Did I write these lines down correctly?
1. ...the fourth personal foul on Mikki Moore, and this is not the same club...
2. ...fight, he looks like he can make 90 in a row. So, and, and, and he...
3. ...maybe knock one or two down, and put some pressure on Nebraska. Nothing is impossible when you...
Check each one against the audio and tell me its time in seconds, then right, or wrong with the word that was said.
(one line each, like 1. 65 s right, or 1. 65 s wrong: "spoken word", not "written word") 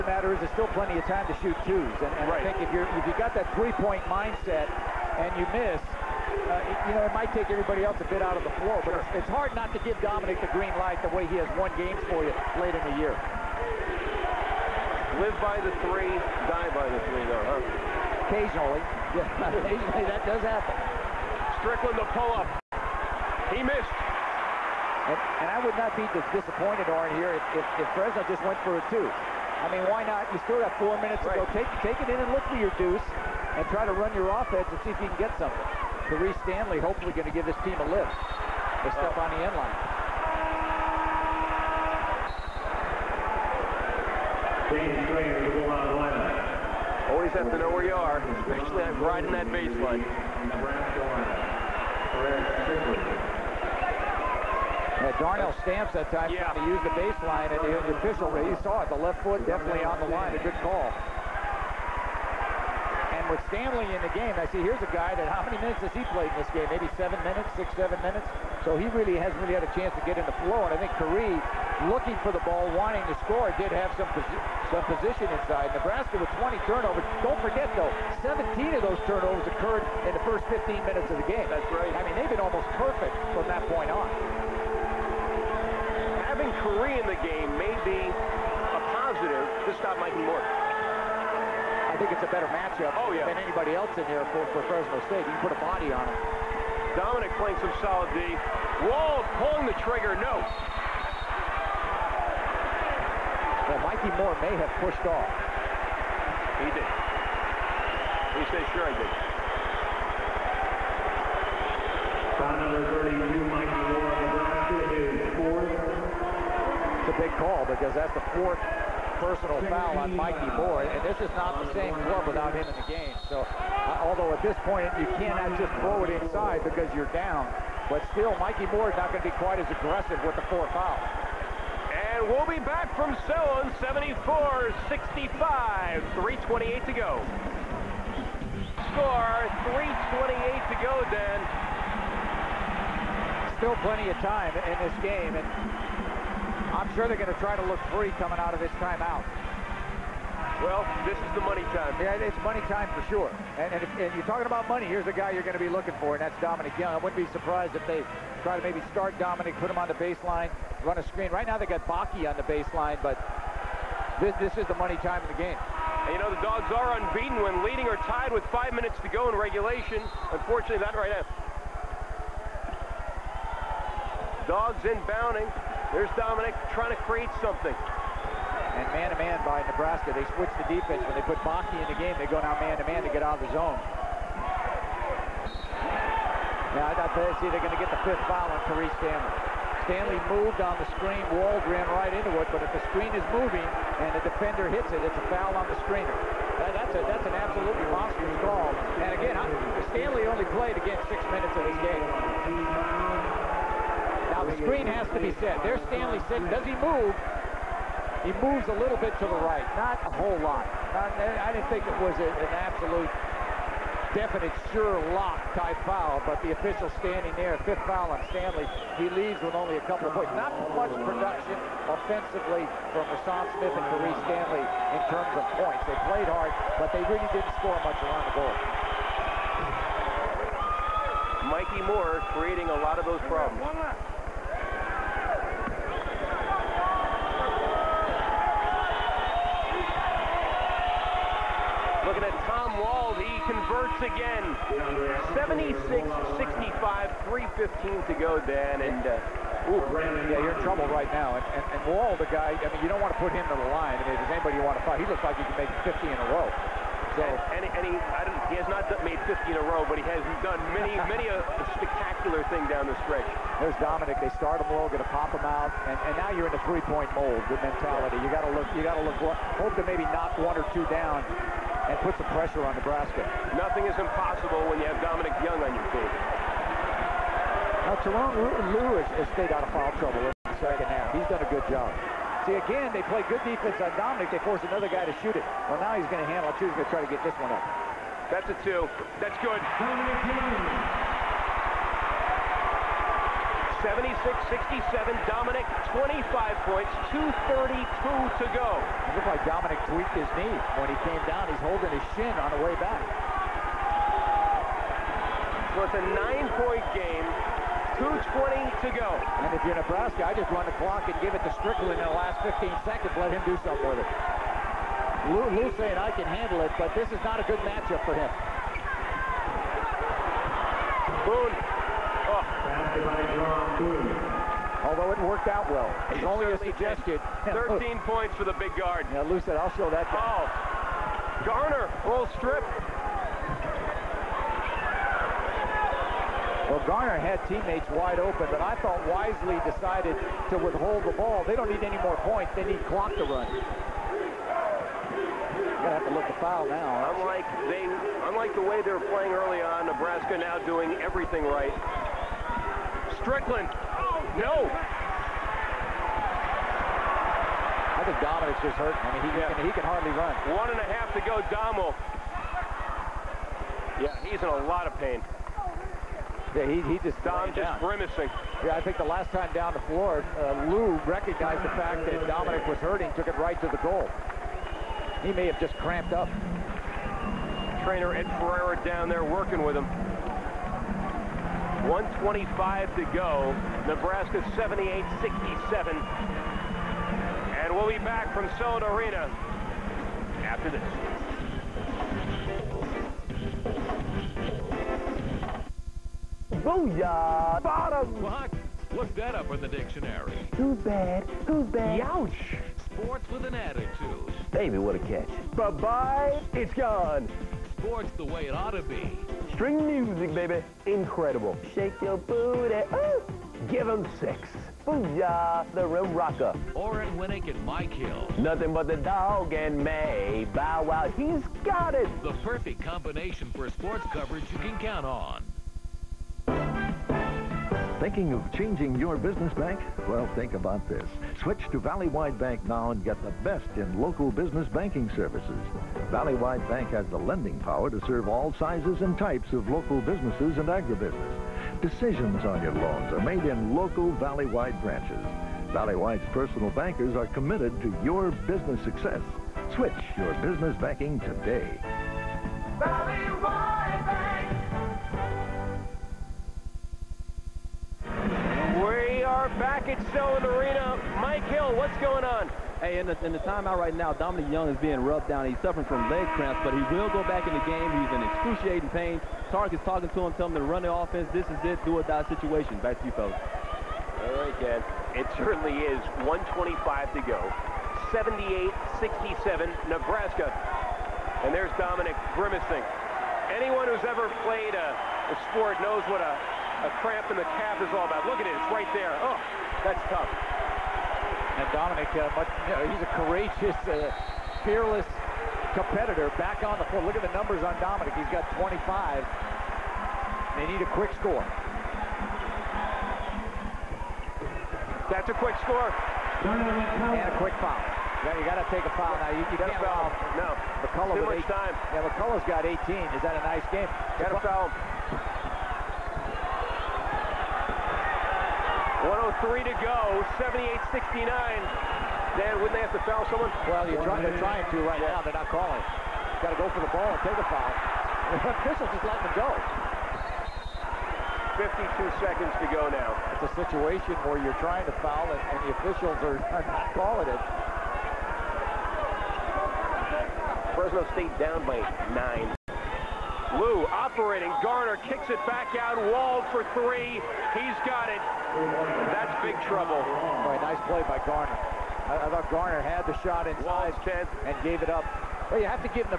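1. 118 s right
2. 254 s wrong: "50", not "90"
3. 269 s right.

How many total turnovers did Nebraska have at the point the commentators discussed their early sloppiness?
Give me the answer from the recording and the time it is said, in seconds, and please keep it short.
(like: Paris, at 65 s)
20, at 76 s.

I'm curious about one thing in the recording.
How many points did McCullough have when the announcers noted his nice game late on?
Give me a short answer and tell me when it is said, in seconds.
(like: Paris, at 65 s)
18, at 512 s.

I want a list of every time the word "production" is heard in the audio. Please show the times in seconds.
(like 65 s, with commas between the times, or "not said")
221 s.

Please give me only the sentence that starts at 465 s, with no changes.
He's suffering from leg cramps, but he will go back in the game.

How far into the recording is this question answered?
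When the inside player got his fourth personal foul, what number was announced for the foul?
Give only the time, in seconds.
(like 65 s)
112 s.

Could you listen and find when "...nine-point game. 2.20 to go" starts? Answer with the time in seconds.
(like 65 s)
306 s.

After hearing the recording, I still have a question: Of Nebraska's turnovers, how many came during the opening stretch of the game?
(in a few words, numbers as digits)
17.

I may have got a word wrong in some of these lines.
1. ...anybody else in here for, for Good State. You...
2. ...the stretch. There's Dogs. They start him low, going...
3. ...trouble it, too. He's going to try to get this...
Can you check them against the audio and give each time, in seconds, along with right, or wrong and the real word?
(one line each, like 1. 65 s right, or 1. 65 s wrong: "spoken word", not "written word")
1. 93 s wrong: "Fresno", not "Good"
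2. 262 s wrong: "Dominic", not "Dogs"
3. 286 s wrong: "handle", not "trouble".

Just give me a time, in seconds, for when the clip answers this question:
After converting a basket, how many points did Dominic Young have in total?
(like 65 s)
295 s.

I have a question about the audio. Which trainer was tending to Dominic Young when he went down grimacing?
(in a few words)
Ed Ferreira.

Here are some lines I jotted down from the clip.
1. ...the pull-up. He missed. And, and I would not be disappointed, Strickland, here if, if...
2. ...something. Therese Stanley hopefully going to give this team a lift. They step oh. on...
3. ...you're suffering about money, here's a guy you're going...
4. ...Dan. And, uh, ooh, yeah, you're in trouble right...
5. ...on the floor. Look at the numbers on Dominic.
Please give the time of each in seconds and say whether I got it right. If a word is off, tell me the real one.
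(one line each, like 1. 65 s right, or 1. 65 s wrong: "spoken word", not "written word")
1. 21 s wrong: "Orrin", not "Strickland"
2. 35 s right
3. 154 s wrong: "talking", not "suffering"
4. 248 s right
5. 496 s right.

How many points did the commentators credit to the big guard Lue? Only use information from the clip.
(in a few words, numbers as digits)
13.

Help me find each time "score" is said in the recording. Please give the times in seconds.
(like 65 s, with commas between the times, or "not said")
73 s, 138 s, 227 s, 501 s, 505 s.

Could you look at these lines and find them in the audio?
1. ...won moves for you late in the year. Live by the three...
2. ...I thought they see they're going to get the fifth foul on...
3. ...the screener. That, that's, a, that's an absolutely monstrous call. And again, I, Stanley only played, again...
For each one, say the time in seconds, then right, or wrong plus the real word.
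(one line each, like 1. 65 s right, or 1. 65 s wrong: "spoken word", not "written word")
1. 11 s wrong: "games", not "moves"
2. 186 s right
3. 195 s right.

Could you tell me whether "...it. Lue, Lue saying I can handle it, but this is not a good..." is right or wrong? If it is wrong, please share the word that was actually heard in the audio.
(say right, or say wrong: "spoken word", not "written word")
right.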